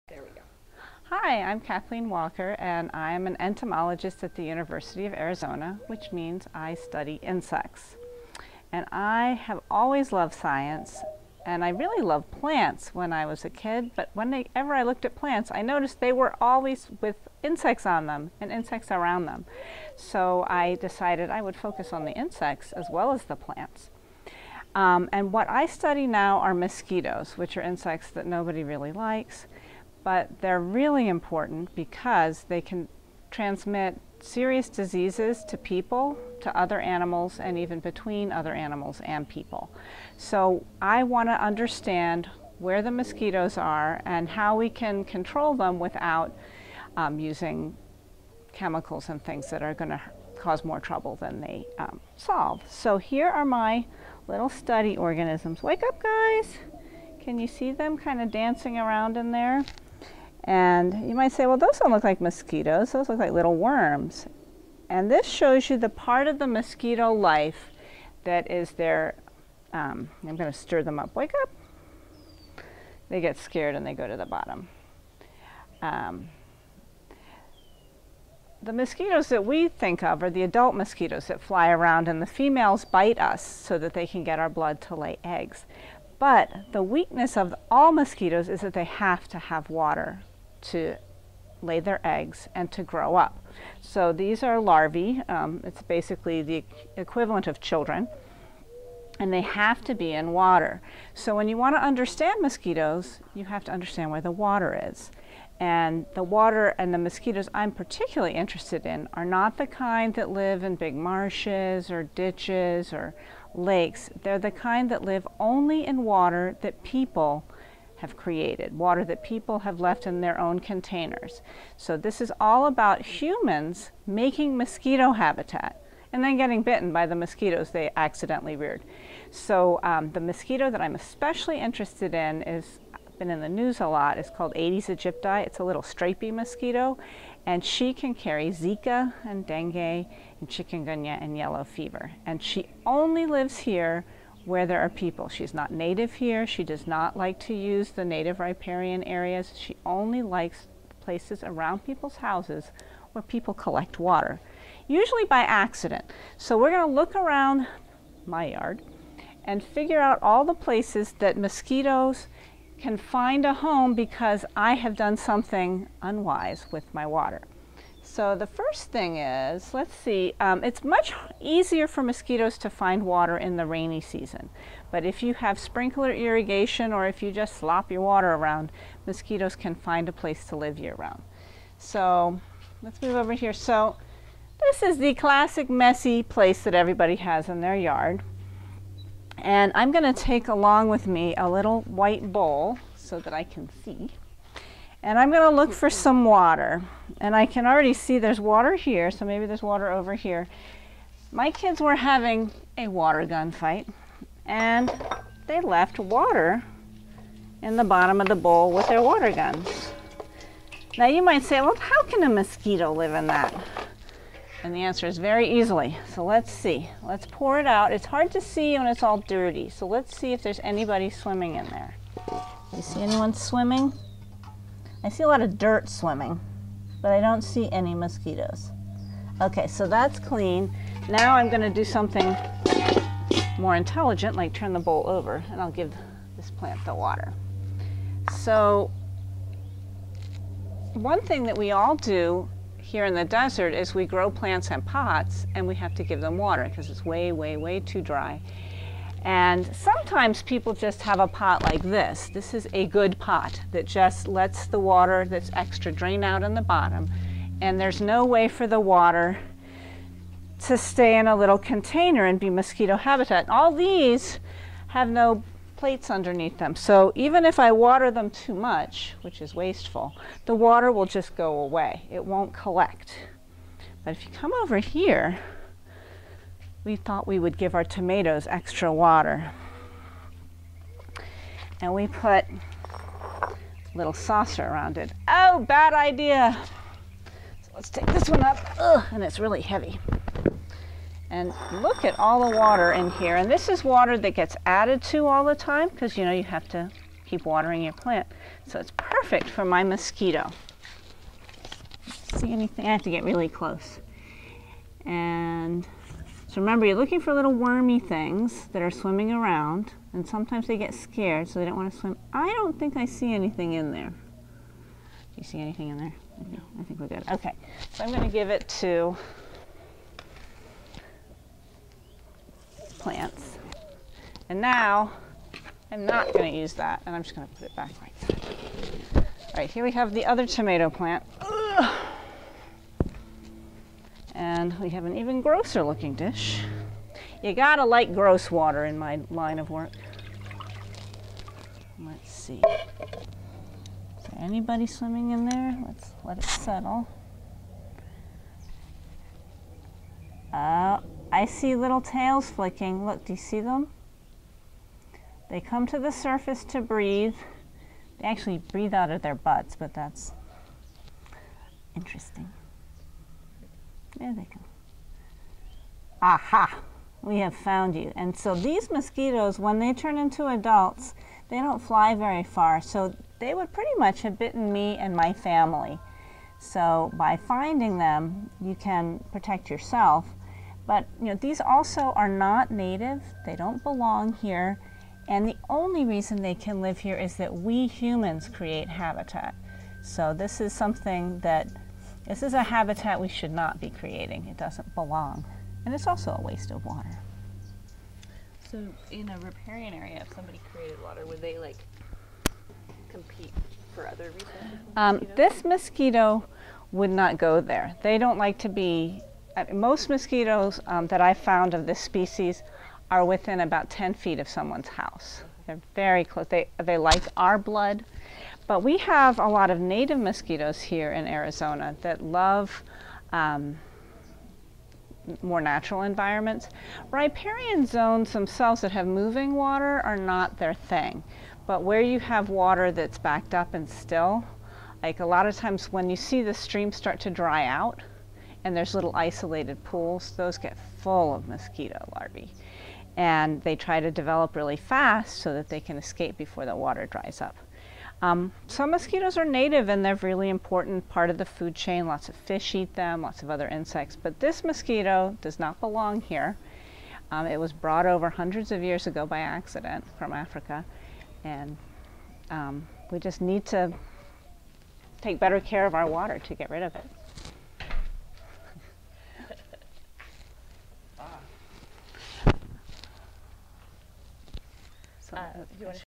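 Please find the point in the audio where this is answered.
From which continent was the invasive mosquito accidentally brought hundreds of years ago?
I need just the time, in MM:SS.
07:40.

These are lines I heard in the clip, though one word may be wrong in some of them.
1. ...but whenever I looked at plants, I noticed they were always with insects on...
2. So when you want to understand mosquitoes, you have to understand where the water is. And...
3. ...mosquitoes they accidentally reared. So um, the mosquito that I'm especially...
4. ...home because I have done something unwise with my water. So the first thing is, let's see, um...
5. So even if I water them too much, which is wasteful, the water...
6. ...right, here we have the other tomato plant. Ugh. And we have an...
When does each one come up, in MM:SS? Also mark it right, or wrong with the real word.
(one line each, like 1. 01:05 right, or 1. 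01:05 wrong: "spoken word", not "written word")
1. 00:13 right
2. 01:41 right
3. 02:07 right
4. 02:43 right
5. 04:26 right
6. 05:29 right.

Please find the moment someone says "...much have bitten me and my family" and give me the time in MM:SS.
06:13.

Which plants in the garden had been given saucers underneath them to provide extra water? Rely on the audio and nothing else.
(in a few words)
tomatoes.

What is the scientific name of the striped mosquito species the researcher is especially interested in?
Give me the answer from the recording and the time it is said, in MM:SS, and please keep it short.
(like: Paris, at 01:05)
Aedes aegypti, at 02:14.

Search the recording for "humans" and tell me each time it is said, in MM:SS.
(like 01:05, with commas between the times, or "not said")
02:03, 06:27.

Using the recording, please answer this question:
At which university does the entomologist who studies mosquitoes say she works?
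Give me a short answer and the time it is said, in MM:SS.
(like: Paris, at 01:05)
University of Arizona, at 00:04.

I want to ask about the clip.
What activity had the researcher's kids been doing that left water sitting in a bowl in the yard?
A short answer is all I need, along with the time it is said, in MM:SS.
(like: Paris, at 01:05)
water gun fight, at 03:22.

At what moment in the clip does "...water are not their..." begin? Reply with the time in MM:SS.
07:09.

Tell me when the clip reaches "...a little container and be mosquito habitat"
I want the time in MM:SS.
04:21.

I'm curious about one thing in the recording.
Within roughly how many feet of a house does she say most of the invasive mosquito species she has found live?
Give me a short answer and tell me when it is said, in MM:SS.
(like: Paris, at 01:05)
10 feet, at 06:53.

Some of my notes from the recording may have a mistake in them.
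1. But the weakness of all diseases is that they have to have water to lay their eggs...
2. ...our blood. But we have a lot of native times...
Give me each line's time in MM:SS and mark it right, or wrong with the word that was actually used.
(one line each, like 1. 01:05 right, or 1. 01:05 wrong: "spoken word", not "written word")
1. 01:26 wrong: "mosquitoes", not "diseases"
2. 06:57 wrong: "mosquitoes", not "times".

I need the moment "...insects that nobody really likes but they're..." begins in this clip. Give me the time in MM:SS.
00:27.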